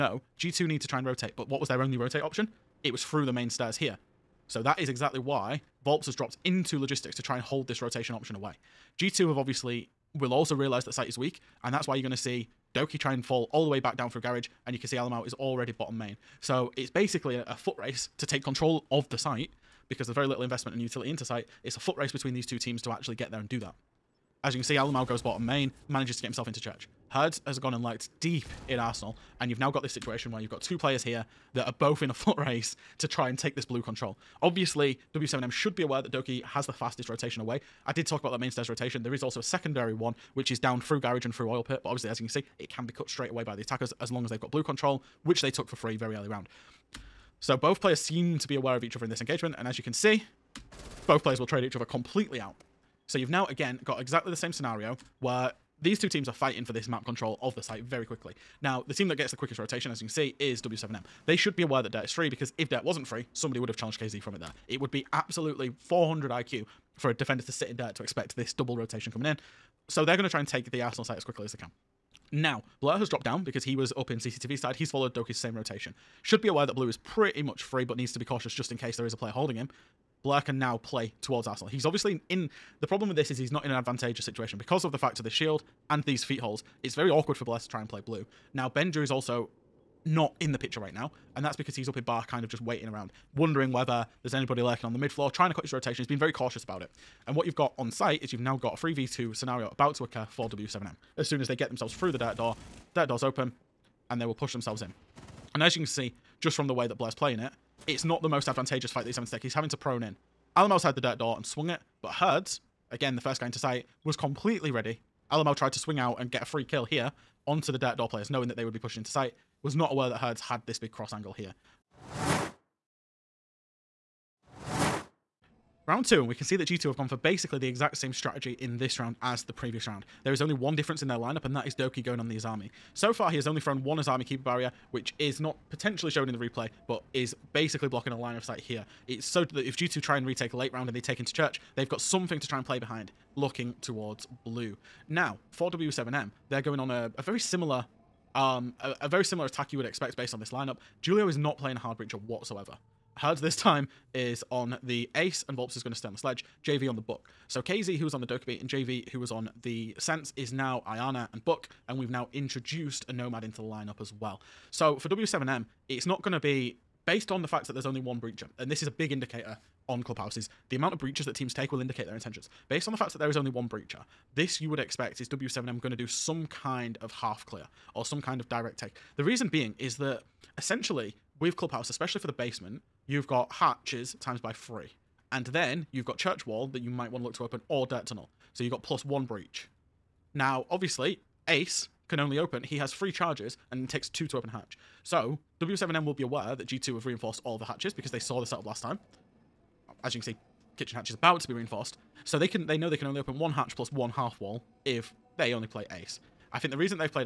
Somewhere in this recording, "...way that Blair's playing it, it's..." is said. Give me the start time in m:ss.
1:46.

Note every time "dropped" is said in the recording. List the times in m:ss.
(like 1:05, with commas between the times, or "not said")
0:06, 1:13.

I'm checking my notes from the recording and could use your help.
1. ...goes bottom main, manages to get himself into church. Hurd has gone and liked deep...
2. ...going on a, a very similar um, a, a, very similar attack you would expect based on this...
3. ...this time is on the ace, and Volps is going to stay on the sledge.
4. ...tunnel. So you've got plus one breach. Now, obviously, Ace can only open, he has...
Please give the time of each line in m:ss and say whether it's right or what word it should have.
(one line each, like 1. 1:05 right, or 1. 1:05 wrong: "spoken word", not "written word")
1. 0:25 right
2. 2:26 right
3. 2:33 right
4. 3:08 right.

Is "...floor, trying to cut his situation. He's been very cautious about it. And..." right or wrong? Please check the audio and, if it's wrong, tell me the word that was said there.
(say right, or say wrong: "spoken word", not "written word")
wrong: "rotation", not "situation".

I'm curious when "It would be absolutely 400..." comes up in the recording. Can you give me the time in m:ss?
1:04.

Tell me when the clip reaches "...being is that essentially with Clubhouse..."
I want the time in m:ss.
2:59.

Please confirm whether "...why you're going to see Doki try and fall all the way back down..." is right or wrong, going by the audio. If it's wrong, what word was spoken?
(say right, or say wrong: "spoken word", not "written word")
right.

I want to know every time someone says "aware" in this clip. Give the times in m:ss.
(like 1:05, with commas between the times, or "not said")
0:35, 0:48, 1:01, 1:16, 1:59, 3:16.